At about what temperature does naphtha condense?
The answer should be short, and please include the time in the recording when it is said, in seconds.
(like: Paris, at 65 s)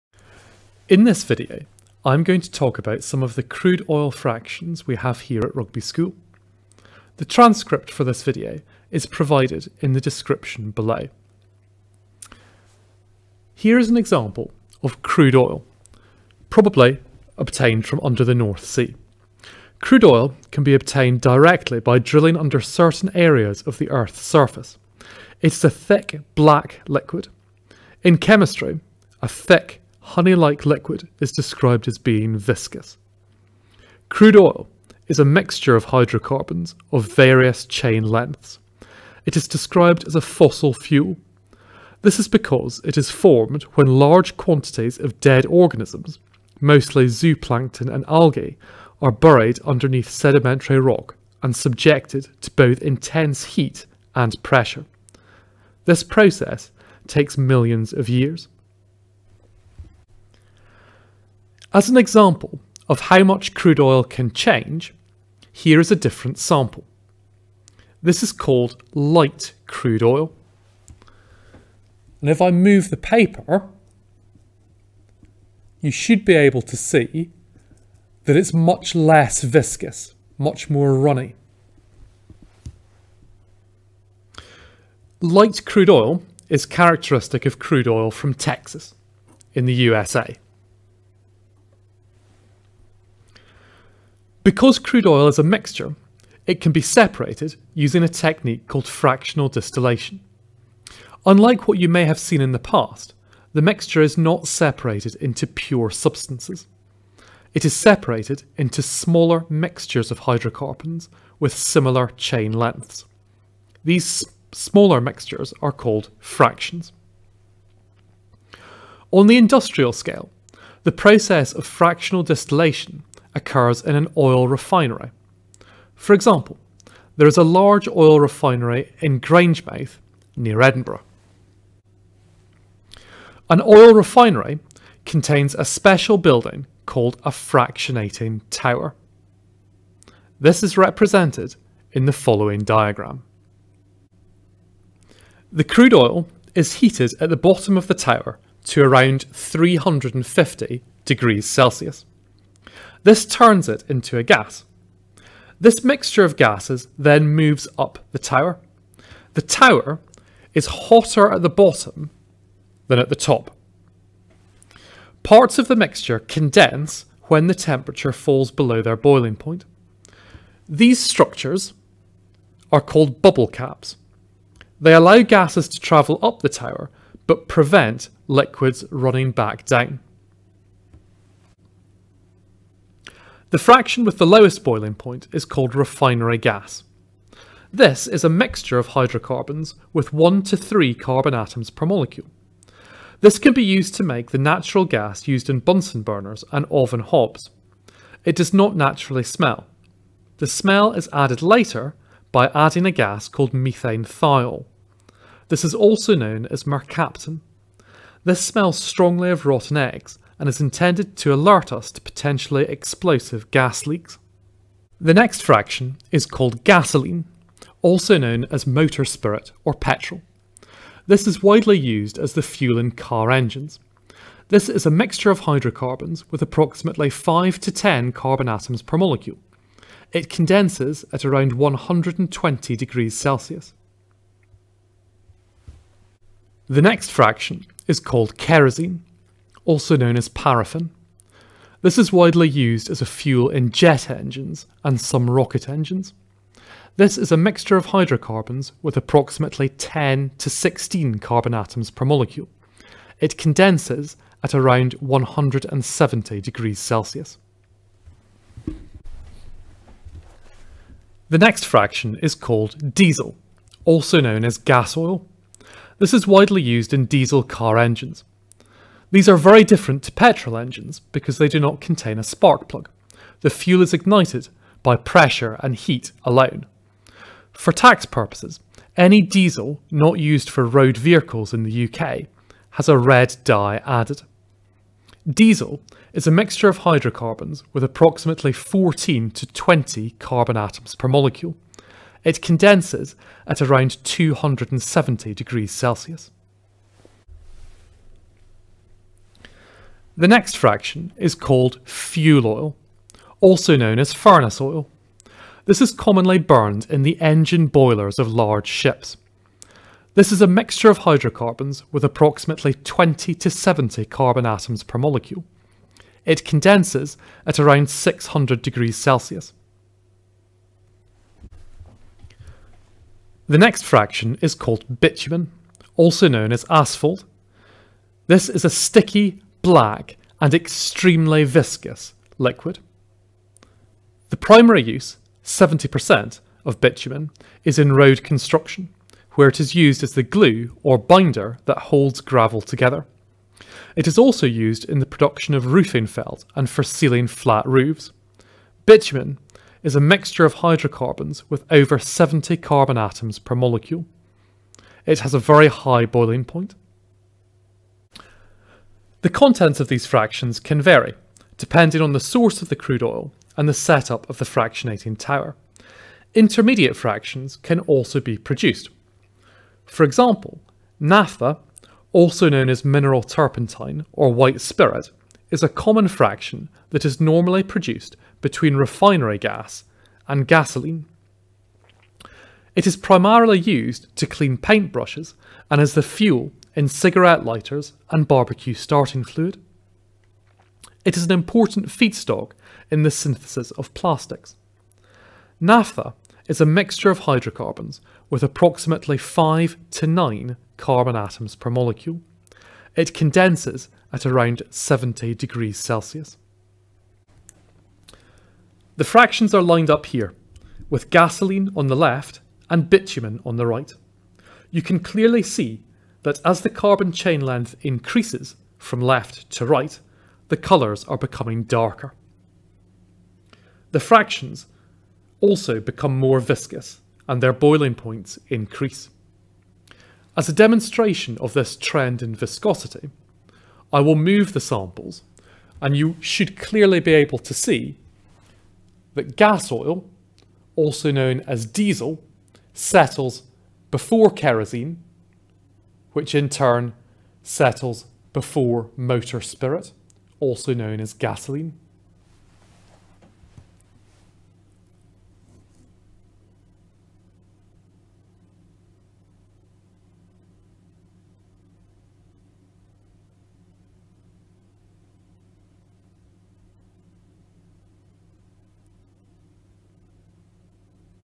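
70 degrees Celsius, at 404 s.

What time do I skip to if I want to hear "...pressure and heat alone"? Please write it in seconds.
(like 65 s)
274 s.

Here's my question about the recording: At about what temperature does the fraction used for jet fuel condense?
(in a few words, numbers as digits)
170 degrees Celsius.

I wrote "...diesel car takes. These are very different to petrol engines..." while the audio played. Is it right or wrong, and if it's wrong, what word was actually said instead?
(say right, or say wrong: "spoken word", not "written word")
wrong: "engines", not "takes".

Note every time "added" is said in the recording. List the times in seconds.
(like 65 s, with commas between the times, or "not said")
201 s, 283 s.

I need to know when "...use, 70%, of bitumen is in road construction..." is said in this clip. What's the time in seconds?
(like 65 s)
334 s.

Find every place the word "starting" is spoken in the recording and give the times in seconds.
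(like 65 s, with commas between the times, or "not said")
388 s.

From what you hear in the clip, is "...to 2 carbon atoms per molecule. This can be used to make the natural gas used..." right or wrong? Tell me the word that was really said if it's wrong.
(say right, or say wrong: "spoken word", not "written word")
wrong: "3", not "2".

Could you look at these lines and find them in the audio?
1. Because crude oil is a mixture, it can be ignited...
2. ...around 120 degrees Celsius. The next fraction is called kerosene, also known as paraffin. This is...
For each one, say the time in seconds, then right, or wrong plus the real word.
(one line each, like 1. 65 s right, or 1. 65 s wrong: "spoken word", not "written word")
1. 94 s wrong: "separated", not "ignited"
2. 231 s right.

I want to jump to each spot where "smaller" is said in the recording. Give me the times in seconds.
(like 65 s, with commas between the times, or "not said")
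108 s, 114 s.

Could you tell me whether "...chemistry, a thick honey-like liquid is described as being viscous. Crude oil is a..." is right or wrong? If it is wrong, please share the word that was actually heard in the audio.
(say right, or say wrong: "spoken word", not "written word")
right.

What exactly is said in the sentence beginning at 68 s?
This is called light crude oil.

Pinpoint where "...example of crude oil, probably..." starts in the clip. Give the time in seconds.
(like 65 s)
13 s.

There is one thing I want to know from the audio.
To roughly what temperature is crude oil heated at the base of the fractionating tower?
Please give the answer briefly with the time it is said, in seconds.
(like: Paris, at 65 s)
350 degrees Celsius, at 149 s.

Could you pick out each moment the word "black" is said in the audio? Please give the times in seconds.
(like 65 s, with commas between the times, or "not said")
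26 s, 329 s.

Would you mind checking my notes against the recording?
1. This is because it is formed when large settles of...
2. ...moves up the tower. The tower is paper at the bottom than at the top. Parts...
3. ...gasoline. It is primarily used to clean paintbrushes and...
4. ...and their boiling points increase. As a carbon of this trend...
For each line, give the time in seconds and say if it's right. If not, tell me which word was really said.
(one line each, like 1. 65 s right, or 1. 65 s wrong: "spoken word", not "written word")
1. 42 s wrong: "quantities", not "settles"
2. 157 s wrong: "hotter", not "paper"
3. 380 s right
4. 427 s wrong: "demonstration", not "carbon".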